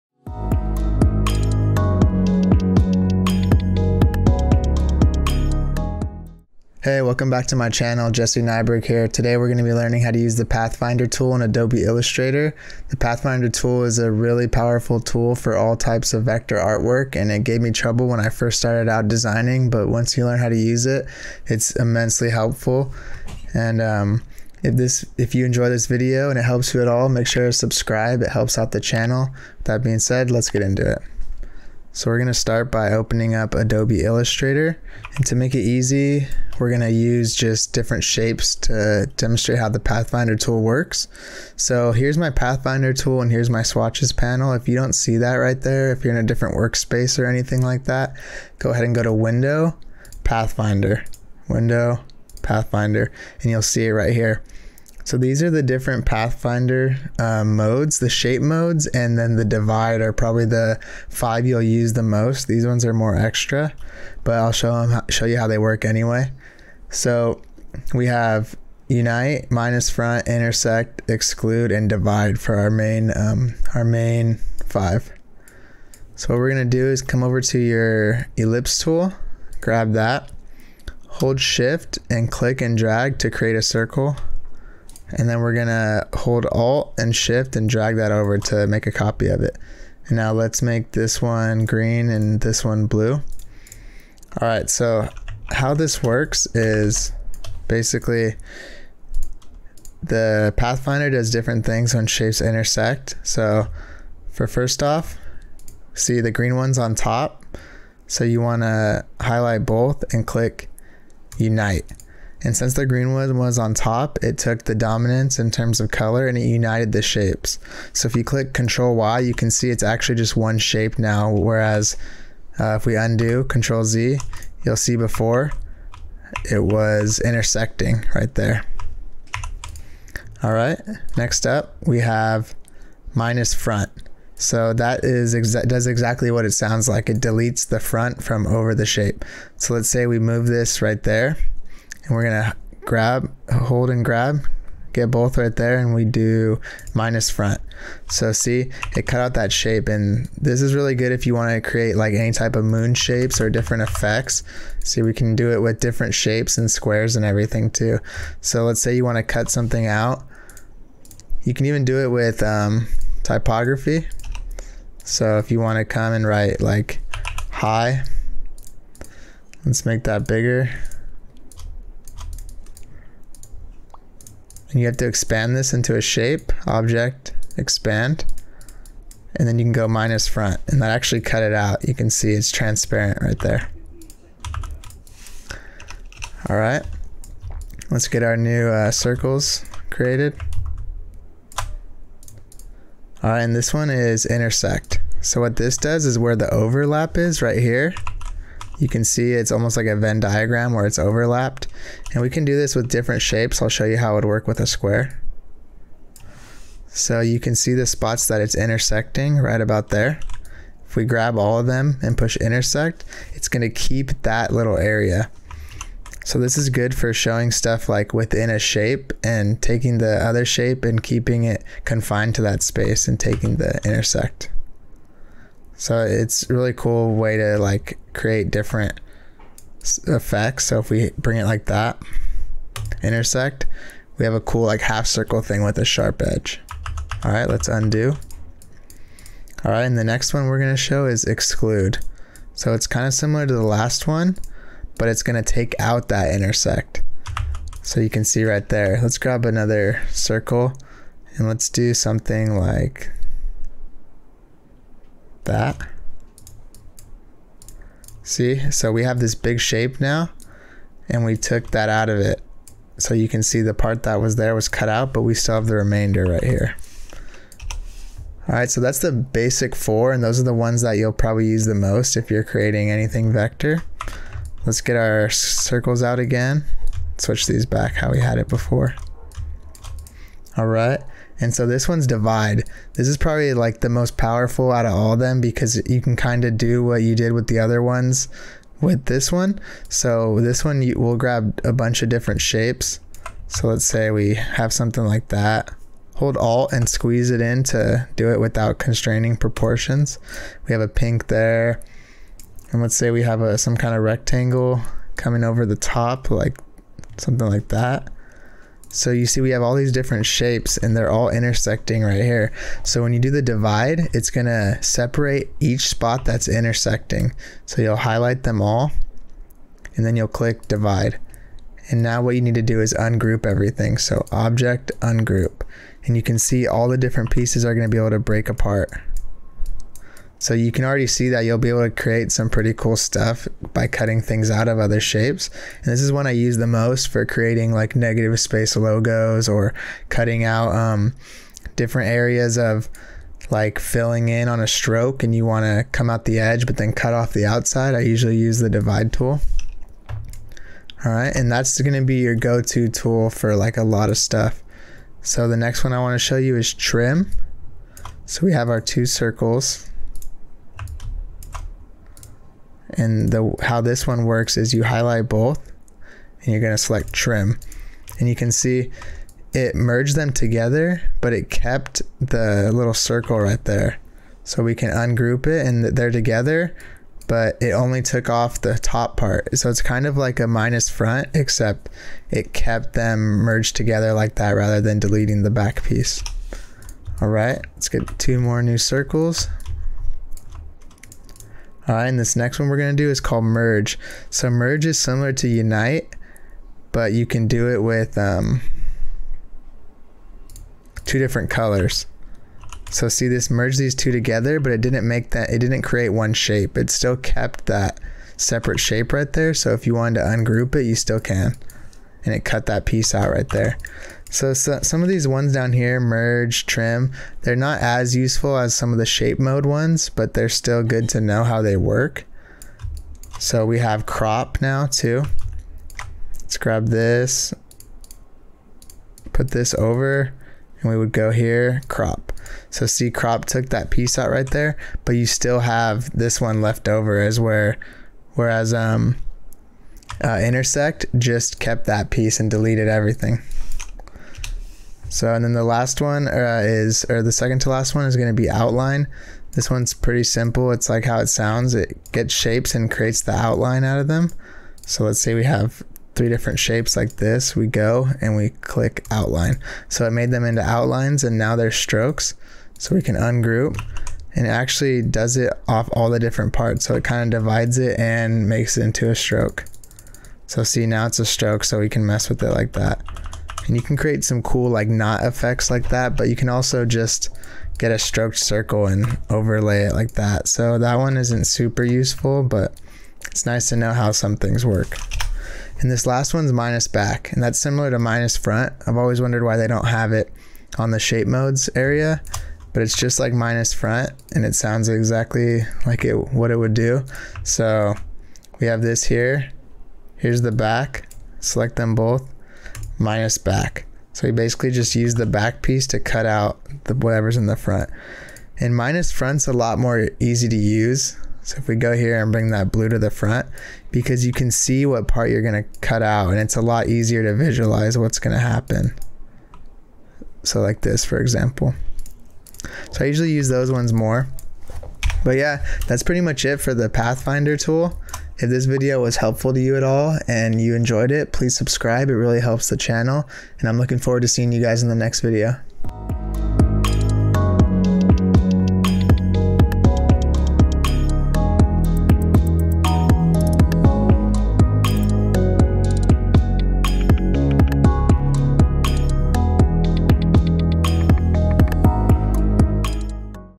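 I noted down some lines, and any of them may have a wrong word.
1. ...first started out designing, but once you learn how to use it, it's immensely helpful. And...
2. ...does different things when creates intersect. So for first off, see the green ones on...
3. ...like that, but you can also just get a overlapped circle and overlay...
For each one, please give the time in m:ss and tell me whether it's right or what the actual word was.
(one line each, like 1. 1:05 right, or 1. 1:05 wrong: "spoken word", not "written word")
1. 0:18 right
2. 1:41 wrong: "shapes", not "creates"
3. 7:55 wrong: "stroked", not "overlapped".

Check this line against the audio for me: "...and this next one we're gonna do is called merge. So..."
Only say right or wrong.
right.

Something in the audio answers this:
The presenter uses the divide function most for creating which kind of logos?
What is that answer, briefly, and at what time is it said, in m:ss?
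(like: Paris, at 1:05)
Negative space logos, at 5:37.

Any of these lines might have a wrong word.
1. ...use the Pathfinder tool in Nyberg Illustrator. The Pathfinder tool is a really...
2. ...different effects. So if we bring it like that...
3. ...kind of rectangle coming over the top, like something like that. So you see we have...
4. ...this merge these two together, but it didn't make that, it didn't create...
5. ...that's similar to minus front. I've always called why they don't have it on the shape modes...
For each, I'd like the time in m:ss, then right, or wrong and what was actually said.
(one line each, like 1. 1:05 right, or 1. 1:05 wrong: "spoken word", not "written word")
1. 0:10 wrong: "Adobe", not "Nyberg"
2. 3:48 right
3. 5:03 right
4. 6:43 right
5. 8:07 wrong: "wondered", not "called".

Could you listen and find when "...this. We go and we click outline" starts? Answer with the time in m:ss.
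7:37.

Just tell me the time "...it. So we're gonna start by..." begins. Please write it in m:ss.
0:30.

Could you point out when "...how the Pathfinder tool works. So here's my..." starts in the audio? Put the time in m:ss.
0:39.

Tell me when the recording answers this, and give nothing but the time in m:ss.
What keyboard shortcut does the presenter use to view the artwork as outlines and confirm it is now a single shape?
1:58.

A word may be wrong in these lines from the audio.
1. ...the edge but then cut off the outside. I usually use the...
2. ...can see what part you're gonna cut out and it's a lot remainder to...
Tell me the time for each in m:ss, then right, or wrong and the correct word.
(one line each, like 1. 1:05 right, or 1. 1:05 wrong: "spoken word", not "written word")
1. 5:46 right
2. 8:34 wrong: "easier", not "remainder".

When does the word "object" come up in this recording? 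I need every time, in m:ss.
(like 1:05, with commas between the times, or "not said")
2:56, 5:24.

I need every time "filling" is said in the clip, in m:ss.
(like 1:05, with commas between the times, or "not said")
5:43.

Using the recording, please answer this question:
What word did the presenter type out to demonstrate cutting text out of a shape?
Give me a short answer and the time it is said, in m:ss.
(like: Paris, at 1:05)
High, at 2:47.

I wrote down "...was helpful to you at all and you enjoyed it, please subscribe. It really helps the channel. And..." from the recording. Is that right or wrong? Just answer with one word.
right.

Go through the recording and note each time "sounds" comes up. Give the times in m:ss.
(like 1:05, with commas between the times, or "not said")
2:16, 7:31, 8:14.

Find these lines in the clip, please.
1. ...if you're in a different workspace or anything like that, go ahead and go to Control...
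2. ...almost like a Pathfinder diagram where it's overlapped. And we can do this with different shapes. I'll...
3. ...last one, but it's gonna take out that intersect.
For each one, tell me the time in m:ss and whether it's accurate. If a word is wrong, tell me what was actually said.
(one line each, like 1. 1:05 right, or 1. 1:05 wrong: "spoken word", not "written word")
1. 0:45 wrong: "Window", not "Control"
2. 3:19 wrong: "Venn", not "Pathfinder"
3. 4:03 right.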